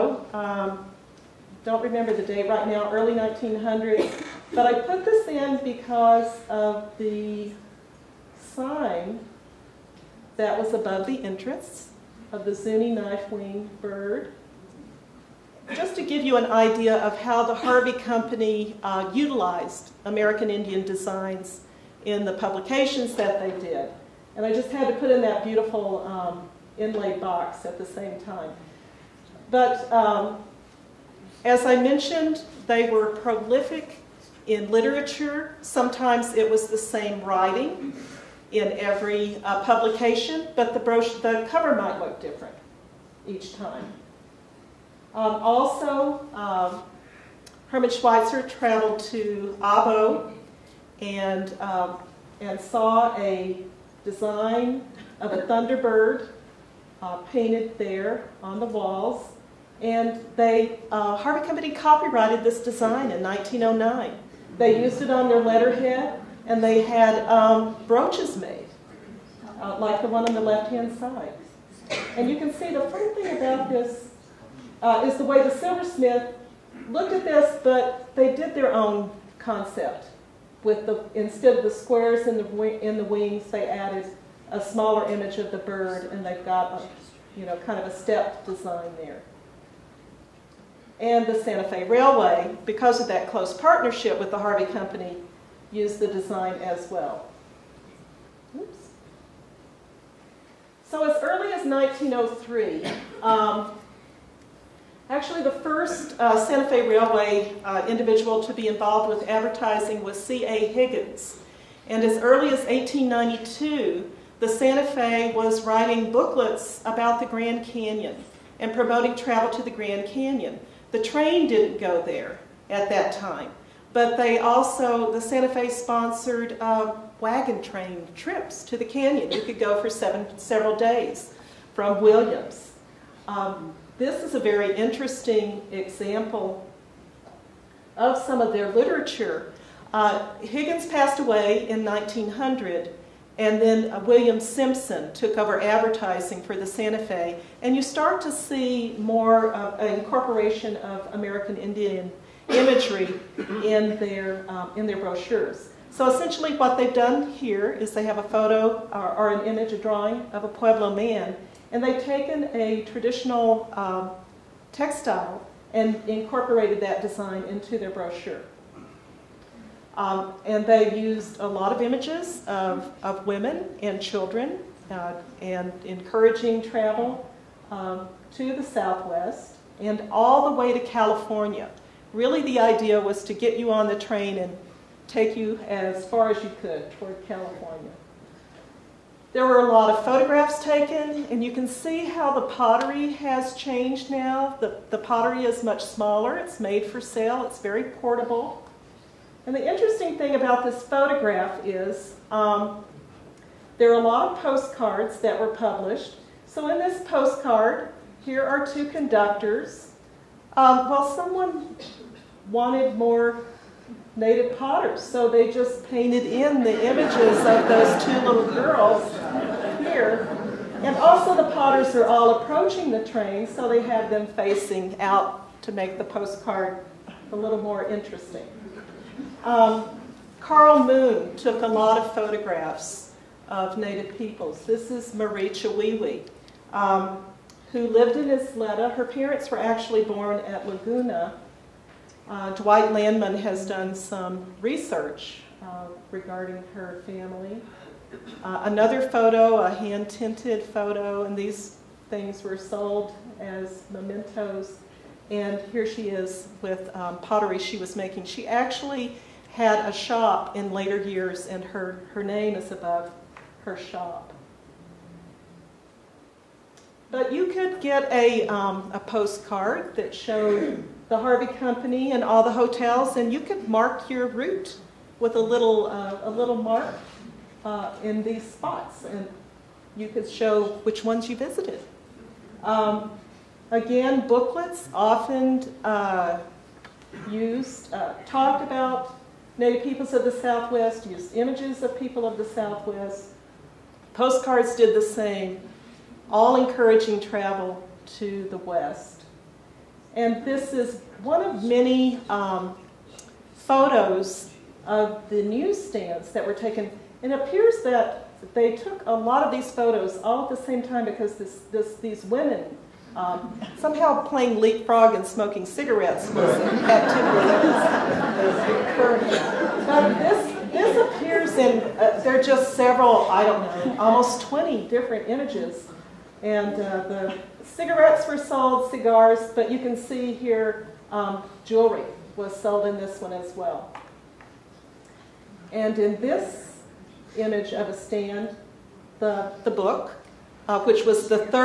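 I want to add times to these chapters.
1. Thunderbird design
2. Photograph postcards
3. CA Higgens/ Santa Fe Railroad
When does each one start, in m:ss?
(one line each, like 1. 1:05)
1. 0:45
2. 3:15
3. 1:43.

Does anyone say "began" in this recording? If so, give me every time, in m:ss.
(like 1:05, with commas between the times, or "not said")
not said.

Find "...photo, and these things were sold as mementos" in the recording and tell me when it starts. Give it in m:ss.
4:10.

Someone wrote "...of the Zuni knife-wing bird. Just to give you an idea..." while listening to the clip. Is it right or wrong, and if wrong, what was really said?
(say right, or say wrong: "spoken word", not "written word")
right.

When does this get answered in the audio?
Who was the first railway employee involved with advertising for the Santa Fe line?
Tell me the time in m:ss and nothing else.
1:50.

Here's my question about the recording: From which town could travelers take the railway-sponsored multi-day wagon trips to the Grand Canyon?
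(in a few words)
Williams.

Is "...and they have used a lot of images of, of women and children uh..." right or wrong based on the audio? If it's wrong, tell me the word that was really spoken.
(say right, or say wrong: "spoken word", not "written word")
right.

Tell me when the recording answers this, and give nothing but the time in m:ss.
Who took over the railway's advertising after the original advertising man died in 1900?
2:23.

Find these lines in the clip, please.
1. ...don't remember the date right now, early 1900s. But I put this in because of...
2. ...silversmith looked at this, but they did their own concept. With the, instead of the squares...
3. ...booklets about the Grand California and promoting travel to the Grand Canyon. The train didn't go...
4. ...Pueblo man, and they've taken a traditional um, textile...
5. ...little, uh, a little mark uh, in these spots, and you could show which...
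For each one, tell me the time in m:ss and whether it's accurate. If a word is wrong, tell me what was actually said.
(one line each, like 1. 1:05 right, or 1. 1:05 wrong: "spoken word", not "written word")
1. 0:01 right
2. 1:15 right
3. 1:56 wrong: "Canyon", not "California"
4. 2:40 right
5. 4:35 right.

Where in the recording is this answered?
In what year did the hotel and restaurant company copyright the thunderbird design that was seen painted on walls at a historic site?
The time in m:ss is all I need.
1:03.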